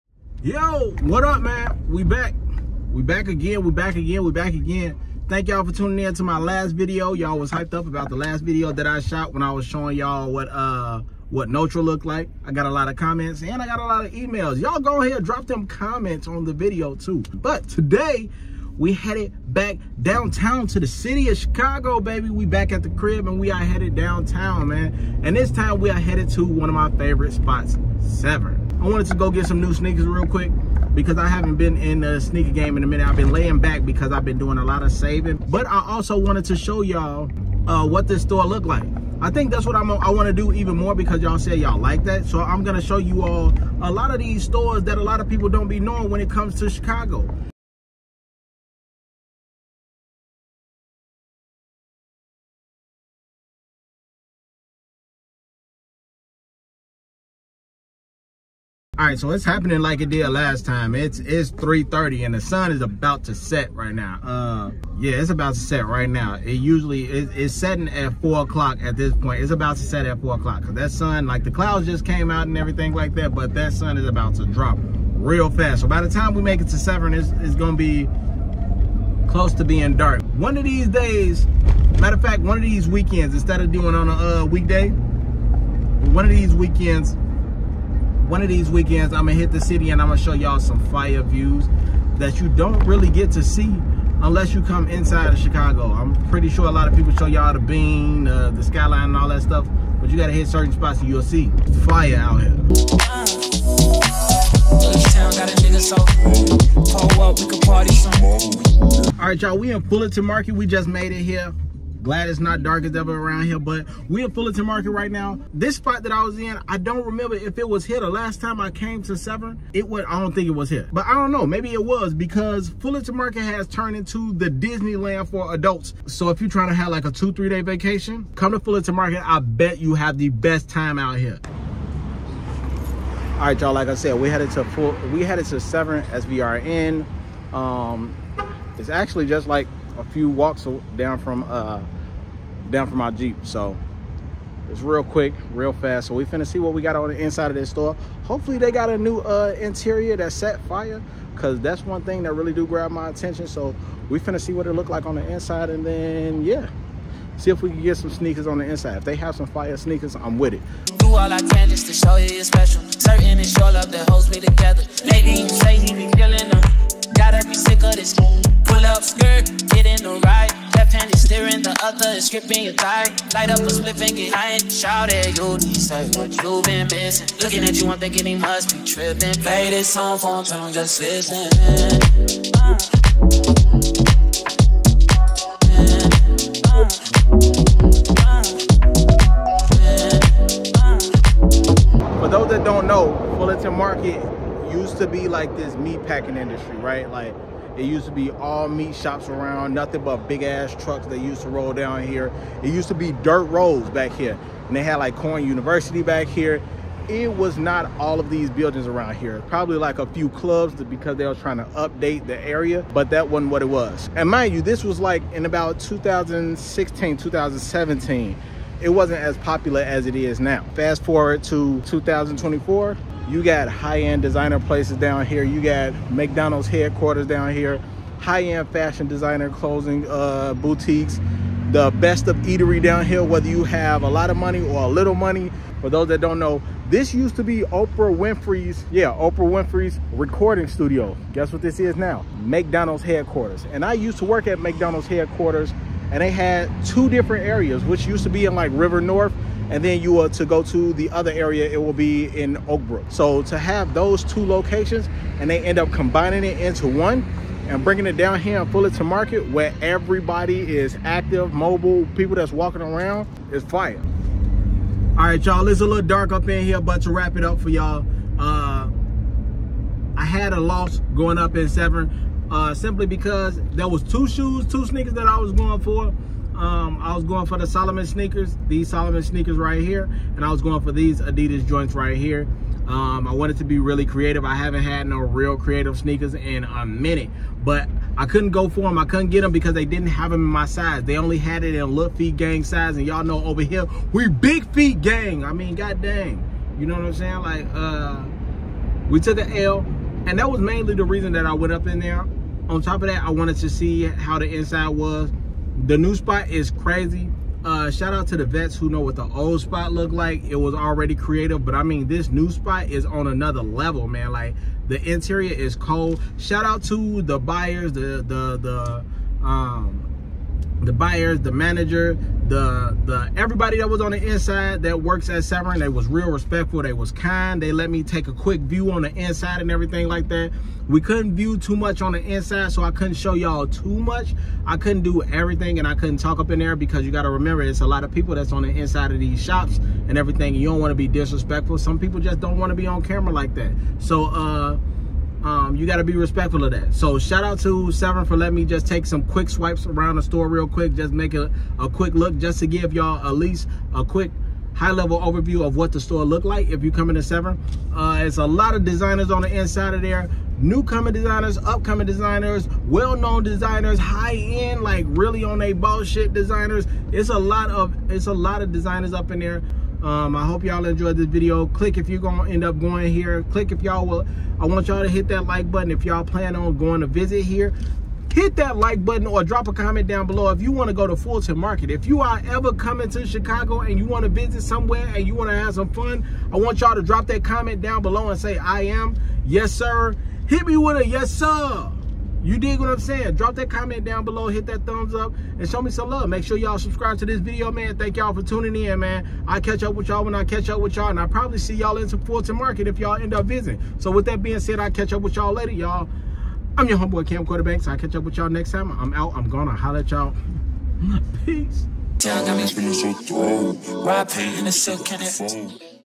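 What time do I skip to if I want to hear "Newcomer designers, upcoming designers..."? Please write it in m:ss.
6:00.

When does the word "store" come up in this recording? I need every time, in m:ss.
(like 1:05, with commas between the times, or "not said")
0:38, 0:44, 2:27, 5:50, 5:55.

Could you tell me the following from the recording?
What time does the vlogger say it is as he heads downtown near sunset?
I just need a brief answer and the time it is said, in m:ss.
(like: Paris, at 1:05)
3:30, at 1:01.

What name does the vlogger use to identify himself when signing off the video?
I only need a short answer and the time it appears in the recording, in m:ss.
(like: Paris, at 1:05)
Camcorder Banks, at 6:47.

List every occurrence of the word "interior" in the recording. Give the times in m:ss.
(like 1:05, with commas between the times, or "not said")
2:29, 5:15.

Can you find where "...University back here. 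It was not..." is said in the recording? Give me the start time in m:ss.
3:25.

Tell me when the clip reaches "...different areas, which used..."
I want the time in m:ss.
4:07.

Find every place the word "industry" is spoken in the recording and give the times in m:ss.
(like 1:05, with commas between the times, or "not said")
3:16.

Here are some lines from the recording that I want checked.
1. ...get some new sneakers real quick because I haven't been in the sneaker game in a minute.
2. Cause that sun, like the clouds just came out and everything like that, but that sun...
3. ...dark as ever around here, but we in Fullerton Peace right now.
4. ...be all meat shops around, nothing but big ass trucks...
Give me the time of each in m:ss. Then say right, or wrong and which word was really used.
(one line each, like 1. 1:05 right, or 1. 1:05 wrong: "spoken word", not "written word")
1. 0:29 right
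2. 1:10 right
3. 1:52 wrong: "Market", not "Peace"
4. 3:18 right.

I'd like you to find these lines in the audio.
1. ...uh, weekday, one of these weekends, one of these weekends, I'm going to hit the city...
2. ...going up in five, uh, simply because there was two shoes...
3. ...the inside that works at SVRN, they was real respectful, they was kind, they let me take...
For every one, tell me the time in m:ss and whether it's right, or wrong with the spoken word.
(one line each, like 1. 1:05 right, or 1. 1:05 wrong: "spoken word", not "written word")
1. 1:24 right
2. 4:31 wrong: "seven", not "five"
3. 5:24 right.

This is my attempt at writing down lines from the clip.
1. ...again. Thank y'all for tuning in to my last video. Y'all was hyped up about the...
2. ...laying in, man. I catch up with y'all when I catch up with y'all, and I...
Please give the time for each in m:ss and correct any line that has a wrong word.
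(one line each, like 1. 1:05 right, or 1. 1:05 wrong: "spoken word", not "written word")
1. 0:04 right
2. 6:38 wrong: "tuning", not "laying".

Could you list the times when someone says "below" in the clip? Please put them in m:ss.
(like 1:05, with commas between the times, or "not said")
6:20, 6:28, 6:34.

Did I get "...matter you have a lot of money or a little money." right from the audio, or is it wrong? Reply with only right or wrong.
wrong.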